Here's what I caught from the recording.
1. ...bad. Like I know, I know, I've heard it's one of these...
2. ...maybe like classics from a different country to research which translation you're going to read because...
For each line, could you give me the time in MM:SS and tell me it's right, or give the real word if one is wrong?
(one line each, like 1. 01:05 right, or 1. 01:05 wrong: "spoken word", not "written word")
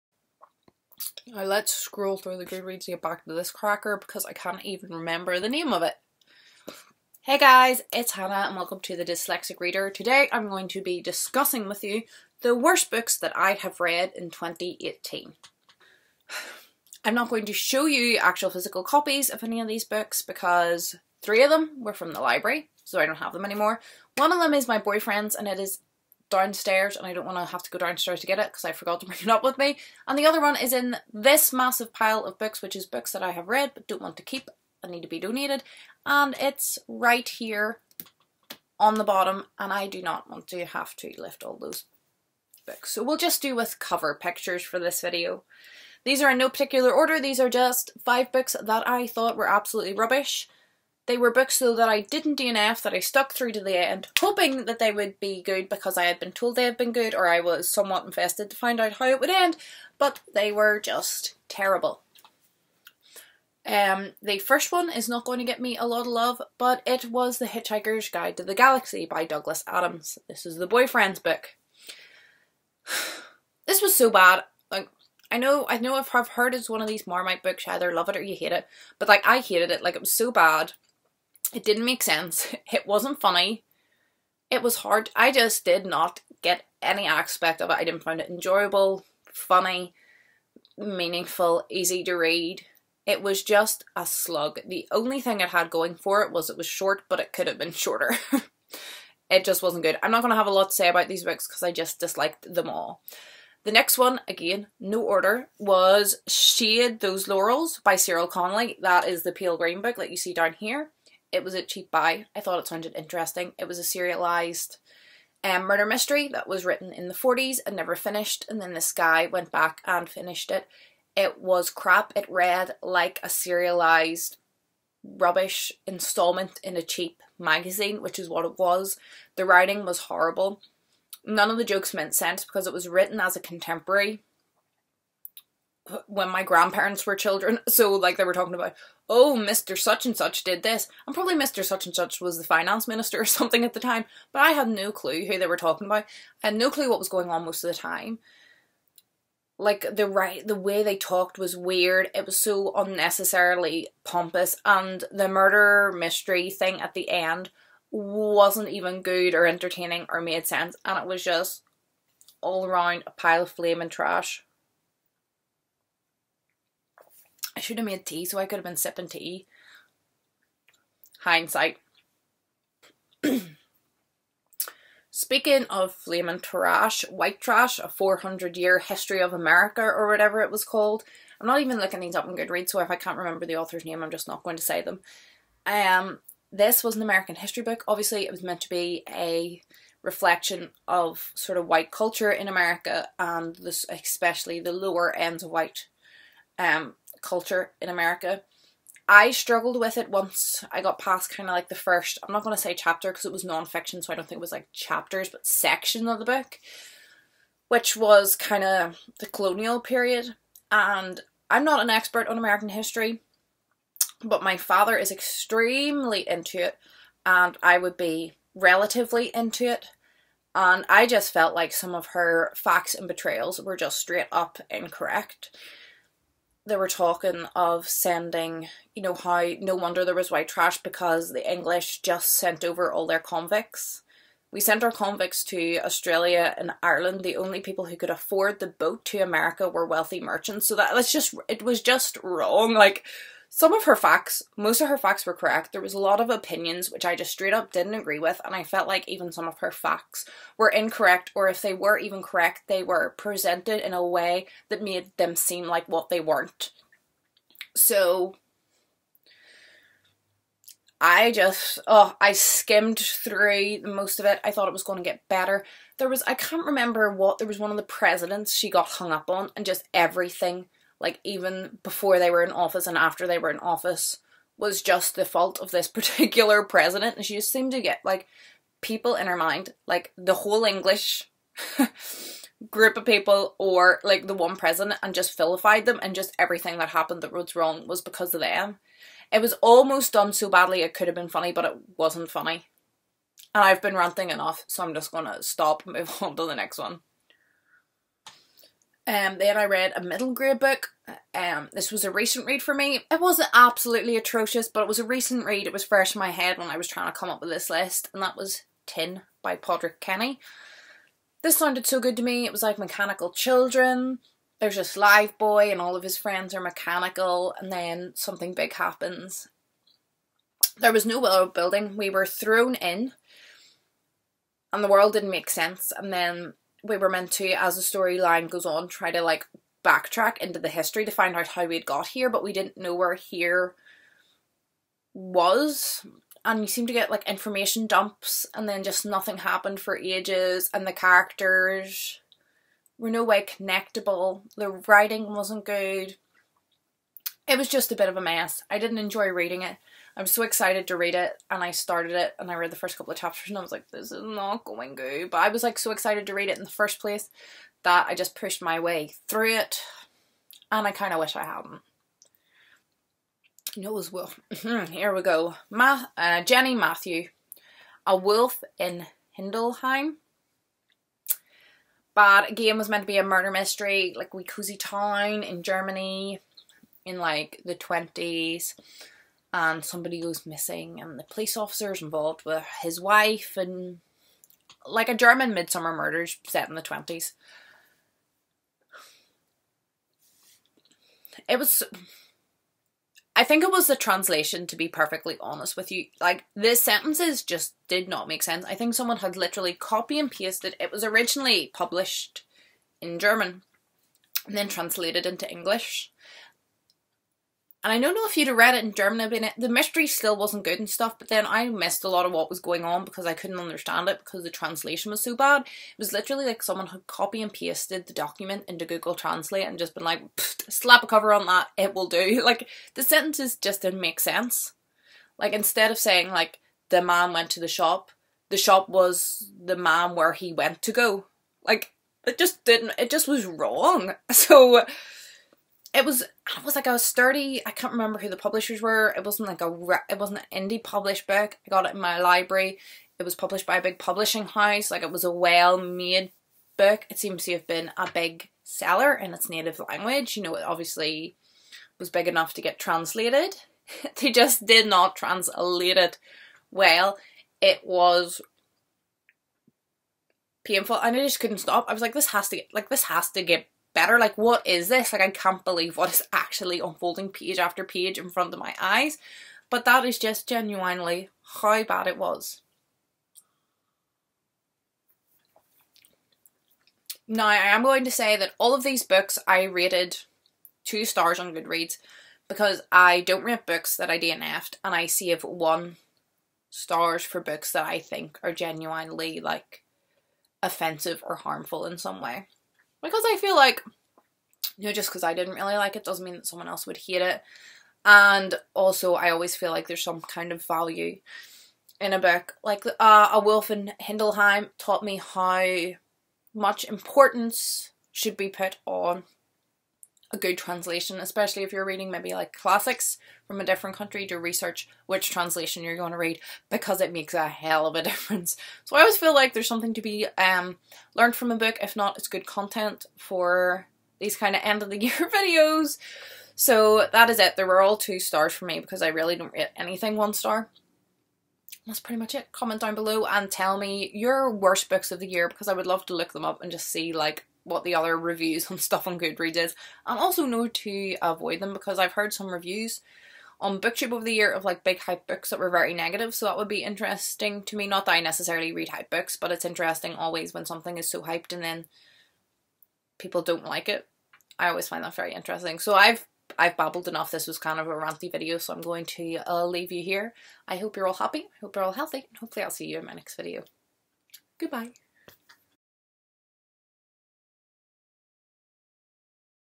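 1. 01:14 right
2. 08:32 right.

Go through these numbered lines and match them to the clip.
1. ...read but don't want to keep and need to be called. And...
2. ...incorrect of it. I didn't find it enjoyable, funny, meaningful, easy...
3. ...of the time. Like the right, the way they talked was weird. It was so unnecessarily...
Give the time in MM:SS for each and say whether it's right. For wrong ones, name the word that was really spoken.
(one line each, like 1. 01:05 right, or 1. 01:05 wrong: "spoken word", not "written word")
1. 00:33 wrong: "donated", not "called"
2. 01:27 wrong: "aspect", not "incorrect"
3. 02:27 right.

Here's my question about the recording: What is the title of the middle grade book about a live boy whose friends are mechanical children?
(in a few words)
Tin.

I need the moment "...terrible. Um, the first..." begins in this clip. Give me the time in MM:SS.
01:01.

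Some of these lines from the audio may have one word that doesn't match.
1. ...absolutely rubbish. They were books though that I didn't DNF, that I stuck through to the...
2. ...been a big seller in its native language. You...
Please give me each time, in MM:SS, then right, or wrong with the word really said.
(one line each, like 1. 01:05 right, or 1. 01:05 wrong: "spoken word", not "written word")
1. 00:49 right
2. 07:27 right.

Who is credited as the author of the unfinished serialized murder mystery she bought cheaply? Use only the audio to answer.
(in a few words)
Cyril Connolly.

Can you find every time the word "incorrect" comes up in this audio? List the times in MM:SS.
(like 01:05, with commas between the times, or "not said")
03:44, 04:10.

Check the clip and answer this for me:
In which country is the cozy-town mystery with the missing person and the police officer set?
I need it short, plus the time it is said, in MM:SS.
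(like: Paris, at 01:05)
Germany, at 06:15.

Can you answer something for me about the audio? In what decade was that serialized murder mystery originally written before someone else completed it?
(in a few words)
the 40s.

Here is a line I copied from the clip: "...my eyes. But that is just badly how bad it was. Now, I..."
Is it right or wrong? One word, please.
wrong.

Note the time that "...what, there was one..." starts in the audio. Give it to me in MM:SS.
04:27.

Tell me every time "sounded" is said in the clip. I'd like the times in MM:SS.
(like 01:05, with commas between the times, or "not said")
01:52, 05:11.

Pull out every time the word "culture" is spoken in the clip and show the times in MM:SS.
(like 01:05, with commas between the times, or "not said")
03:11, 03:17.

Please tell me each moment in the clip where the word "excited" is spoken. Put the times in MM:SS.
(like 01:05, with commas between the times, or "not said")
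05:50, 05:55.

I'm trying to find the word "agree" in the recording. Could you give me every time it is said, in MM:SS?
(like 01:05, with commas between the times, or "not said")
04:07.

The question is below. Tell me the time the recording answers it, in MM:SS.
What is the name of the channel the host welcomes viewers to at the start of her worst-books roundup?
00:08.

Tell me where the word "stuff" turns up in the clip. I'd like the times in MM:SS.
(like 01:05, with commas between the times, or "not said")
06:50, 08:58.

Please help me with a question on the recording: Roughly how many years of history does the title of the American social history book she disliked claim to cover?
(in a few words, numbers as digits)
400.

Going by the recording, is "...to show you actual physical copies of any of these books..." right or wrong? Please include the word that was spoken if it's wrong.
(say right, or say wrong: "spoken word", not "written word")
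right.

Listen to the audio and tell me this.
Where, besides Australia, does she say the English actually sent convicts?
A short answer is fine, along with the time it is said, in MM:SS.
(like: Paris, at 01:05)
Ireland, at 03:56.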